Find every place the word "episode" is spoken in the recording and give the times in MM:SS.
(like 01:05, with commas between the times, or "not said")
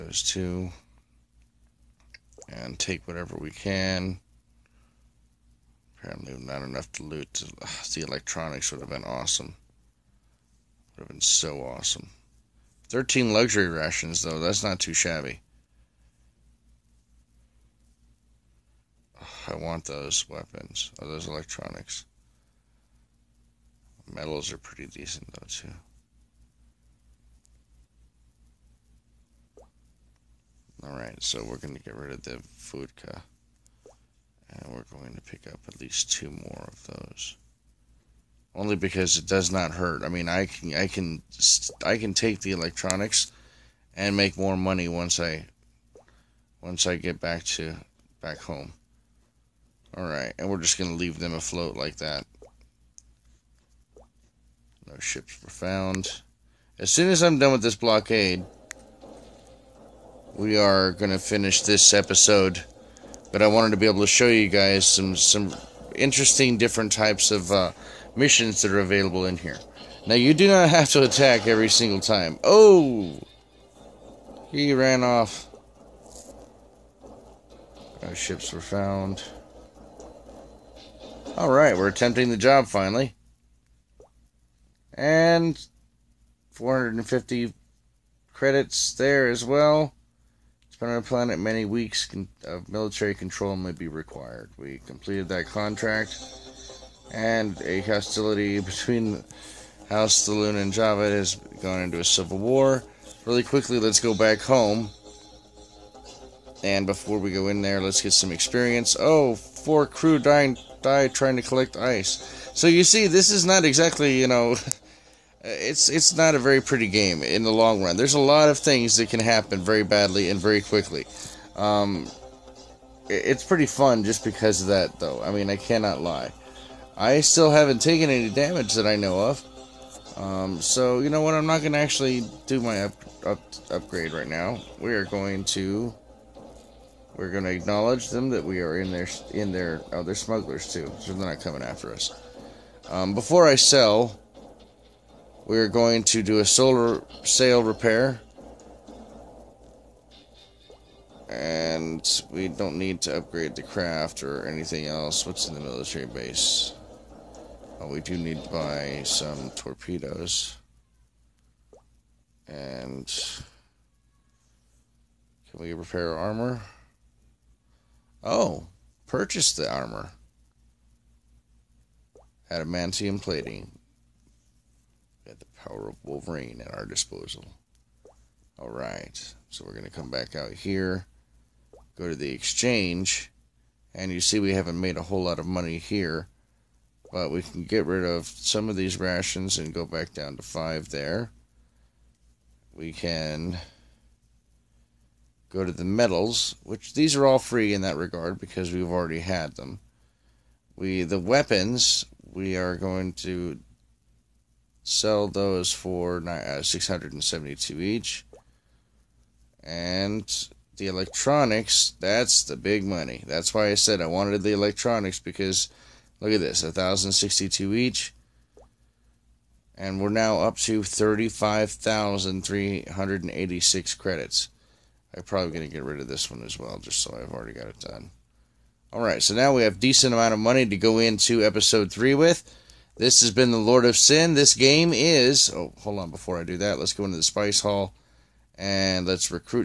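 01:01, 03:51.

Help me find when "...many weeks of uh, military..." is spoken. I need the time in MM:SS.
01:31.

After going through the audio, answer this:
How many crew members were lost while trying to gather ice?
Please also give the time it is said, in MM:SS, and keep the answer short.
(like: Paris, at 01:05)
4, at 01:49.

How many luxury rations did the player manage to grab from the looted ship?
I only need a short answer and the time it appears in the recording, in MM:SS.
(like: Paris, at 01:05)
13, at 00:12.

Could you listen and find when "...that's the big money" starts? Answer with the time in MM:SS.
03:31.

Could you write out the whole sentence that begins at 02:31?
And we don't need to upgrade the craft or anything else.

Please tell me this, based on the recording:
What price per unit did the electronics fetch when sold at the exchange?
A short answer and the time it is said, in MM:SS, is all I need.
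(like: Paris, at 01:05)
1062, at 03:36.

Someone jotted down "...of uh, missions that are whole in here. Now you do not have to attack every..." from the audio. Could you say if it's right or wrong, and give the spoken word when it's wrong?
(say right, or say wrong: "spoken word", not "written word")
wrong: "available", not "whole".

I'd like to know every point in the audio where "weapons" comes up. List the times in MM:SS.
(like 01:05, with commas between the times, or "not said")
00:20, 03:21.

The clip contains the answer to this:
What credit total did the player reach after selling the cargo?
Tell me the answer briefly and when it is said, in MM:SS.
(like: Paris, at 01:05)
35,386 credits, at 03:40.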